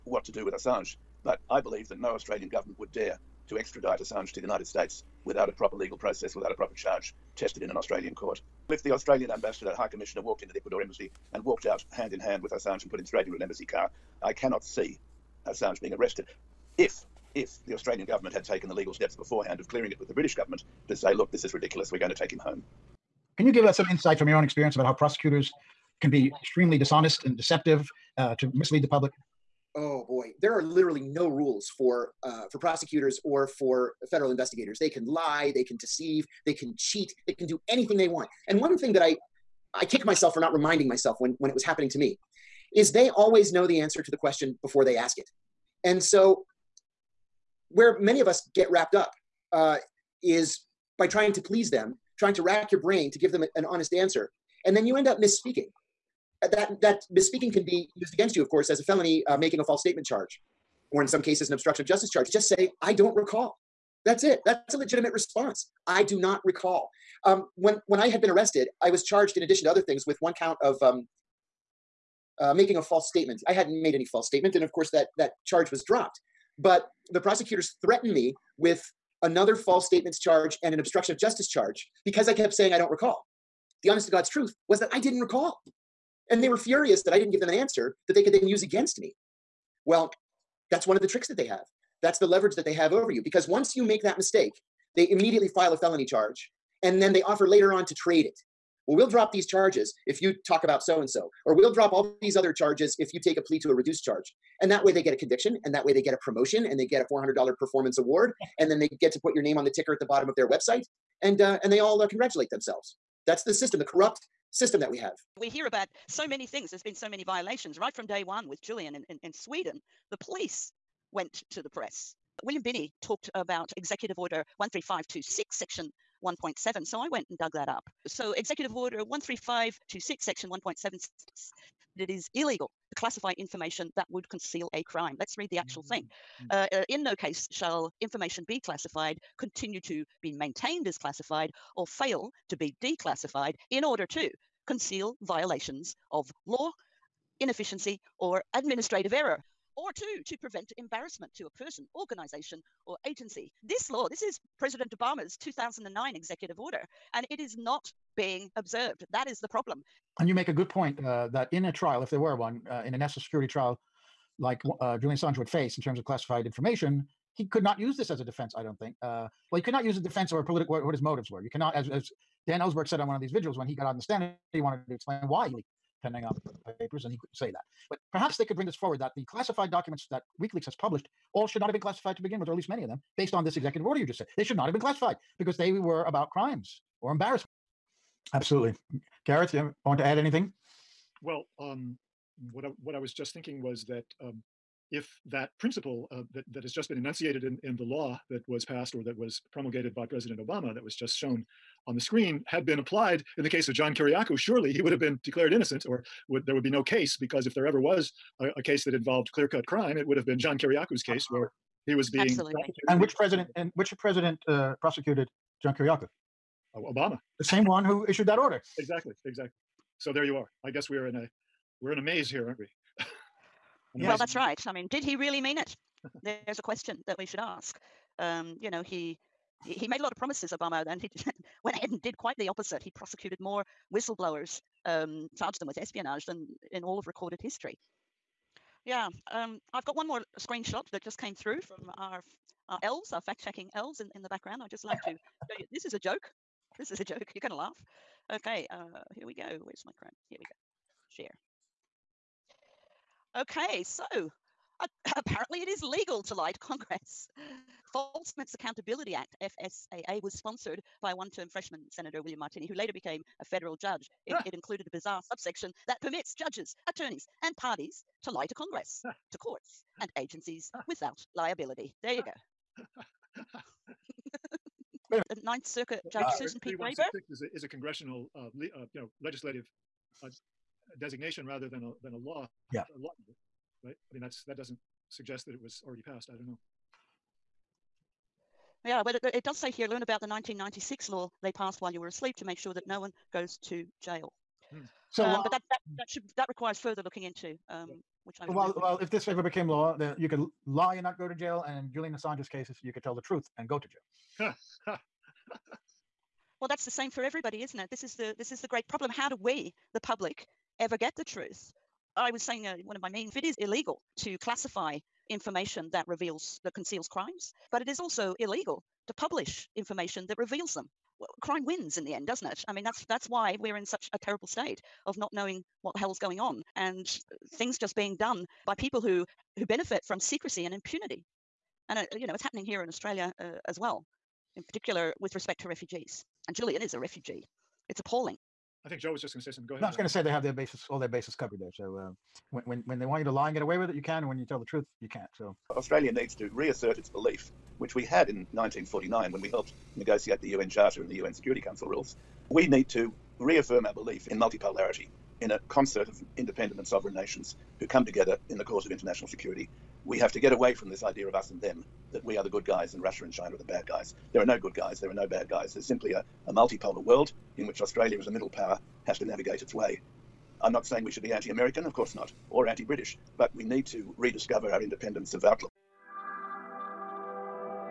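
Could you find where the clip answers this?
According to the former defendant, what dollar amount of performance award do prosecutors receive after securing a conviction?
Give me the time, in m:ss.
1:47.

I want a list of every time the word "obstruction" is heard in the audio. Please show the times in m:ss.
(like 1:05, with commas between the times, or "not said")
1:01, 1:20.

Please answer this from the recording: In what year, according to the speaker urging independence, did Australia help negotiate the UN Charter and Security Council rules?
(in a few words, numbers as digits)
1949.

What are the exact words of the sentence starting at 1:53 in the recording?
That's the system, the corrupt system that we have.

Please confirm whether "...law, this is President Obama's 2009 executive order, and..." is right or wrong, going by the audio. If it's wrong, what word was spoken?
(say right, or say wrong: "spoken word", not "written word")
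right.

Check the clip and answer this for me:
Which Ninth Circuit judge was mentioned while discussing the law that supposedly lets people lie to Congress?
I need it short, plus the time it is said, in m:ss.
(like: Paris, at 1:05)
Susan P. Graber, at 4:36.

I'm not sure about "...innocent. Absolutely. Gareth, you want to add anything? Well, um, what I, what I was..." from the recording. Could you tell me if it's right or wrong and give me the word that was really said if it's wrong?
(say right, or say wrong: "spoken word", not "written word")
wrong: "embarrassment", not "innocent".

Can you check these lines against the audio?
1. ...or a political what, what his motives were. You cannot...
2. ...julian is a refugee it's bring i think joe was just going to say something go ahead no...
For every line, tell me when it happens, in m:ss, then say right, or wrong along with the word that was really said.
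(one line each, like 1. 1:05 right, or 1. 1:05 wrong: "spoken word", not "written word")
1. 2:50 right
2. 5:36 wrong: "appalling", not "bring".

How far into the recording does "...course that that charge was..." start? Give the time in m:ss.
1:14.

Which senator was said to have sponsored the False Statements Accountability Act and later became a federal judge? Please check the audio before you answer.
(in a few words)
William Martini.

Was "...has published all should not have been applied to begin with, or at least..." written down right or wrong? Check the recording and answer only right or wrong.
wrong.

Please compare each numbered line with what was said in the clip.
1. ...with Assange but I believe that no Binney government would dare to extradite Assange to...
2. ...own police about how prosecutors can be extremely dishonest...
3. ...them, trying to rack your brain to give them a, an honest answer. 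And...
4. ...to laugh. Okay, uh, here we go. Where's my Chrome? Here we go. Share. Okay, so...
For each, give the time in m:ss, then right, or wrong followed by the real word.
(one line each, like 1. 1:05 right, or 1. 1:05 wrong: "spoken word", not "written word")
1. 0:00 wrong: "Australian", not "Binney"
2. 0:24 wrong: "experience", not "police"
3. 0:51 right
4. 4:07 right.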